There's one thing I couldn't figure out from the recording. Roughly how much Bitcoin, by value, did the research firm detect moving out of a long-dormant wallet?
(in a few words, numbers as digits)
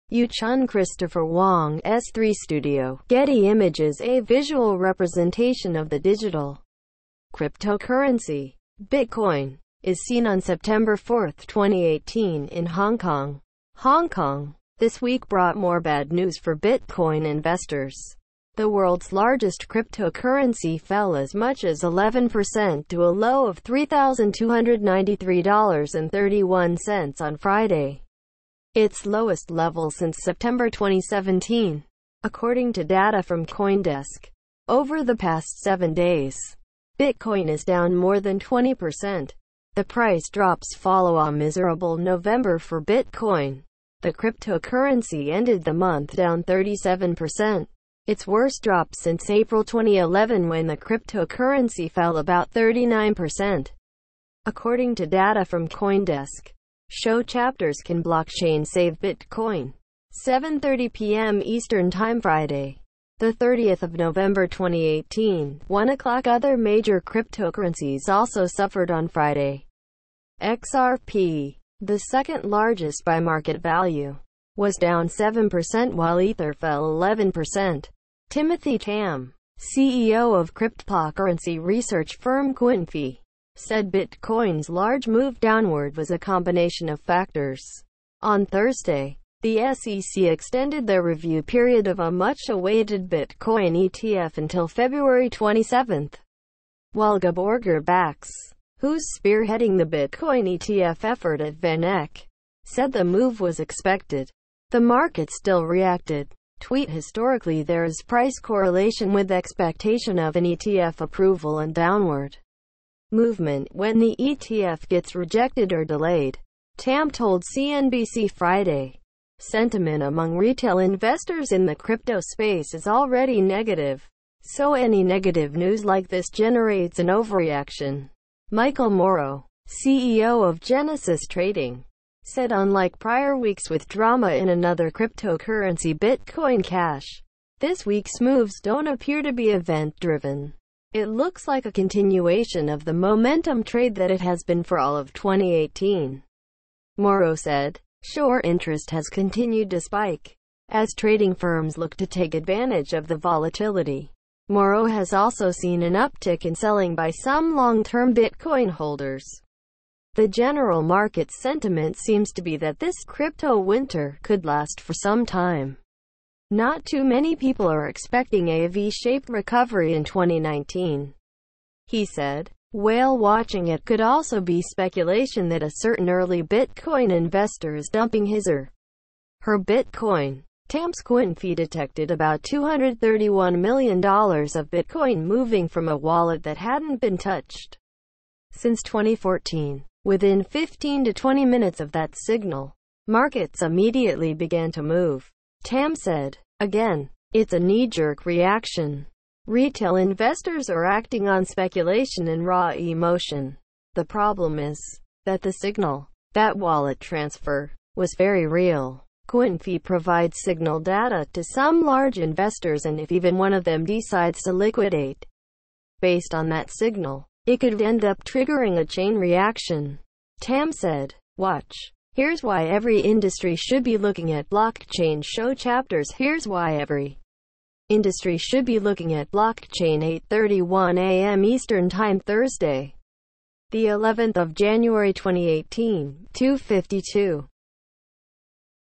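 $231 million.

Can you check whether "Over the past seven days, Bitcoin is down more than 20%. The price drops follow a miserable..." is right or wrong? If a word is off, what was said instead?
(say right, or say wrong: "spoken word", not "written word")
right.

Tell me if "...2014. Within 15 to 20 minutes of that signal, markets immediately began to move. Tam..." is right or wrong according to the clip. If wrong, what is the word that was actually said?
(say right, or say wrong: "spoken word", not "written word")
right.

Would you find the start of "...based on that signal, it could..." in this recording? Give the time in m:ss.
3:36.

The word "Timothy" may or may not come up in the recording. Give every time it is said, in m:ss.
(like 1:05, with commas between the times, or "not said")
1:18.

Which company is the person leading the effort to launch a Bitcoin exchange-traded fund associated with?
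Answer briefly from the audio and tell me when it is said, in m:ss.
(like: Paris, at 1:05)
VanEck, at 1:41.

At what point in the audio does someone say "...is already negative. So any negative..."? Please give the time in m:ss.
2:02.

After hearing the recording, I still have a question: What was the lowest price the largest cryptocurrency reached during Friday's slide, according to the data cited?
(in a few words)
$3,293.31.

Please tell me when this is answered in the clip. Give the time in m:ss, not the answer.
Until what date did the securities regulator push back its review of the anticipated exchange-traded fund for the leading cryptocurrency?
1:34.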